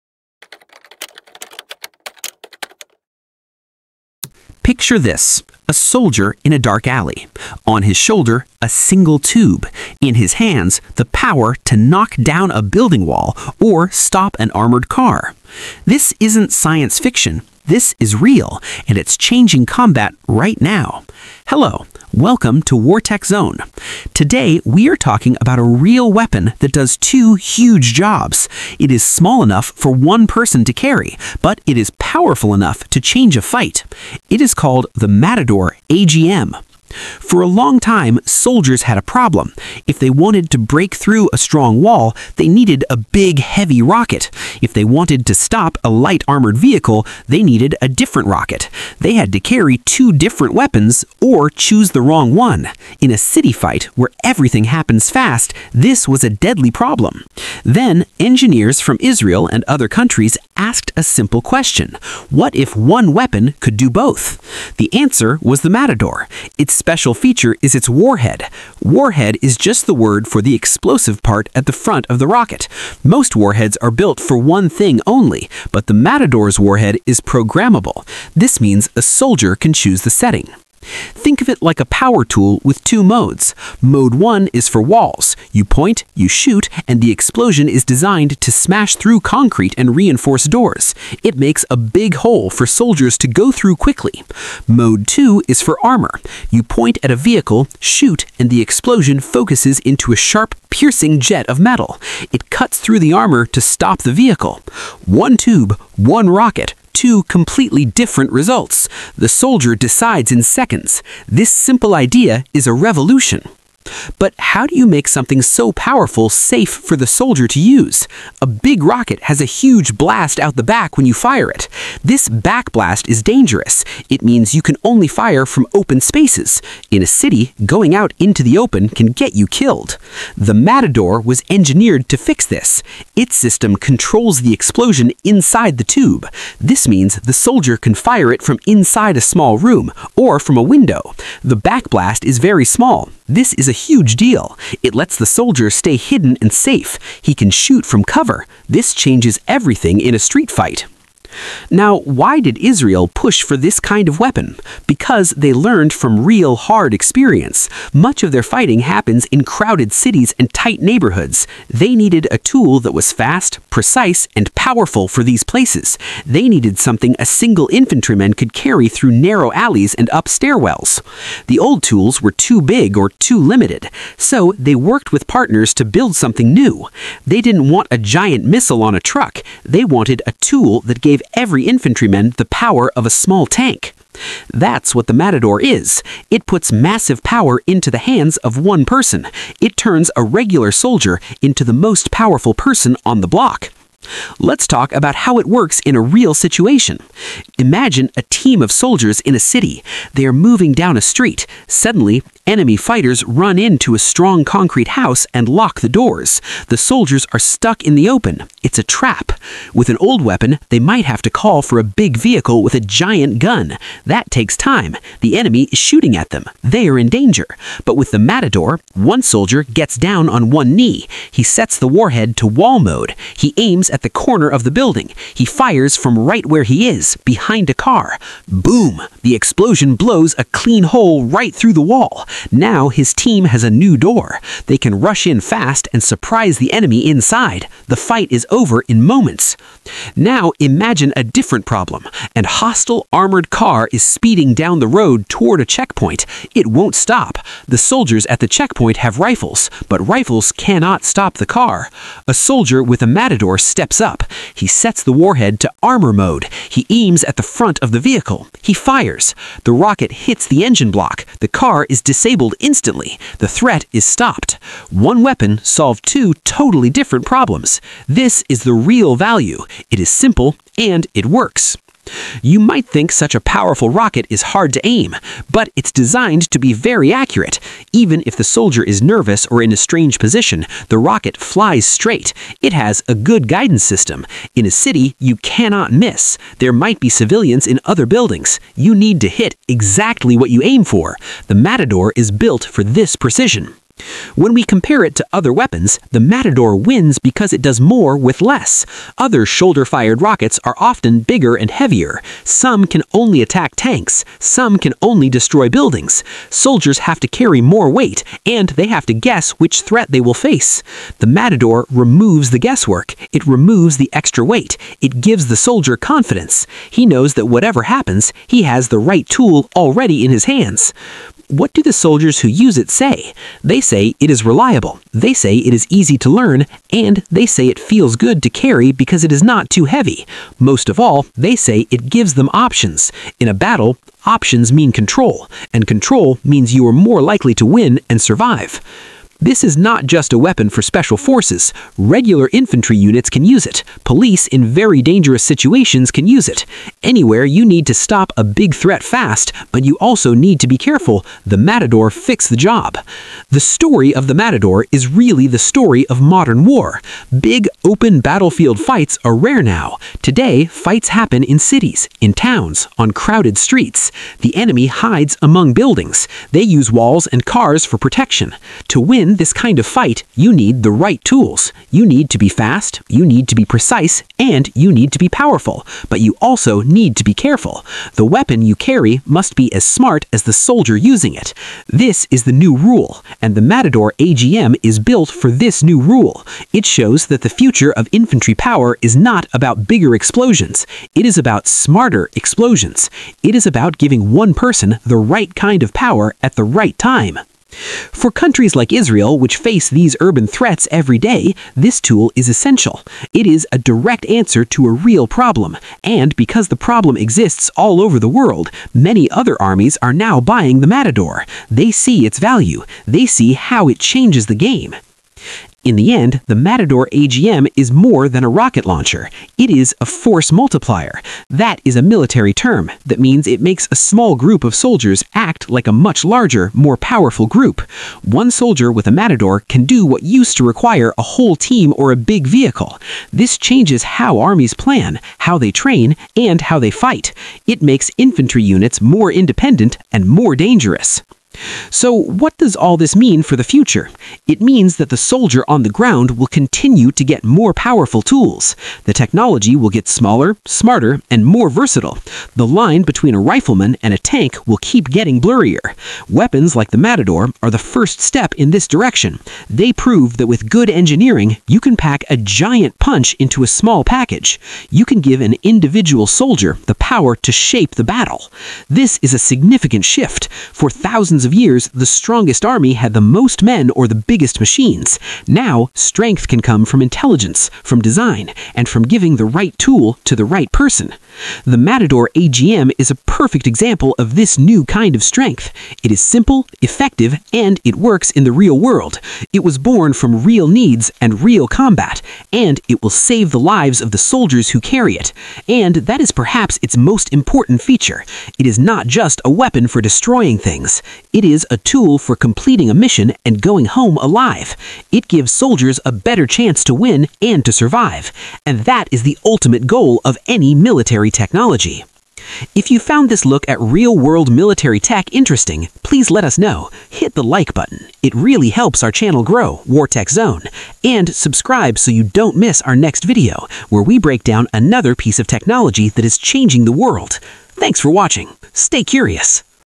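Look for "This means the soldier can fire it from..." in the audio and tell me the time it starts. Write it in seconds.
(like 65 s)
136 s.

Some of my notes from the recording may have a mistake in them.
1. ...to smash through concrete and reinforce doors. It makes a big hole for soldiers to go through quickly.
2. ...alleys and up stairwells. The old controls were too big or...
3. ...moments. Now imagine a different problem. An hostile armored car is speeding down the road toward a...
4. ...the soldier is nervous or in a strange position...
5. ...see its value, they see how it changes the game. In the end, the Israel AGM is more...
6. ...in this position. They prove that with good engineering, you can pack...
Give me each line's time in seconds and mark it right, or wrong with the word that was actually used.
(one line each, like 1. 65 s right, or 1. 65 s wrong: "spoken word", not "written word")
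1. 88 s right
2. 169 s wrong: "tools", not "controls"
3. 239 s right
4. 278 s right
5. 411 s wrong: "Matador", not "Israel"
6. 458 s wrong: "direction", not "position".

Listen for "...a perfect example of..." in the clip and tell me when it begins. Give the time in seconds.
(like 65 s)
483 s.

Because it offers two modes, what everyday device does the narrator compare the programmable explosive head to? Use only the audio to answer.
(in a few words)
A power tool.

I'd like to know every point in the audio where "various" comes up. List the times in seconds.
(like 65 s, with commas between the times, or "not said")
not said.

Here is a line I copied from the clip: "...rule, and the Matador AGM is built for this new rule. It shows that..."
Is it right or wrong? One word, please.
right.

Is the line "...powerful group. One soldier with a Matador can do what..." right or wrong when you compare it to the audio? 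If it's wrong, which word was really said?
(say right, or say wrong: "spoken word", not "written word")
right.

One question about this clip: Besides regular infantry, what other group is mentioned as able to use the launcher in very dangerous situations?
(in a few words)
Police.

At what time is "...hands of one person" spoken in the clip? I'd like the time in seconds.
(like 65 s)
187 s.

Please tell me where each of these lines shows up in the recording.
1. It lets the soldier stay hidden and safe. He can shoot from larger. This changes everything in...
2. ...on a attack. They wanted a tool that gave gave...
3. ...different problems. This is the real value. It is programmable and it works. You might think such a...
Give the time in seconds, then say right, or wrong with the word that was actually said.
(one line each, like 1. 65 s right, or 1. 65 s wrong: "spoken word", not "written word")
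1. 144 s wrong: "cover", not "larger"
2. 178 s wrong: "truck", not "attack"
3. 266 s wrong: "simple", not "programmable".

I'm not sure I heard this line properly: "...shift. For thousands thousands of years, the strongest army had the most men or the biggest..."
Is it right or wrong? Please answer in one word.
right.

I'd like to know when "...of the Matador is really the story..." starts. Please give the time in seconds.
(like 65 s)
354 s.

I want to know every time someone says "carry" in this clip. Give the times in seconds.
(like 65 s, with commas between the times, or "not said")
30 s, 49 s, 168 s, 307 s, 328 s, 378 s, 494 s.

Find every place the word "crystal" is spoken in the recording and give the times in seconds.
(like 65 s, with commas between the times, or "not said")
not said.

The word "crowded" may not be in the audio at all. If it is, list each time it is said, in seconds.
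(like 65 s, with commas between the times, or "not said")
159 s, 363 s.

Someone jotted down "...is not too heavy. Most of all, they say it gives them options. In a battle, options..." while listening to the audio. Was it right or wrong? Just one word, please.
right.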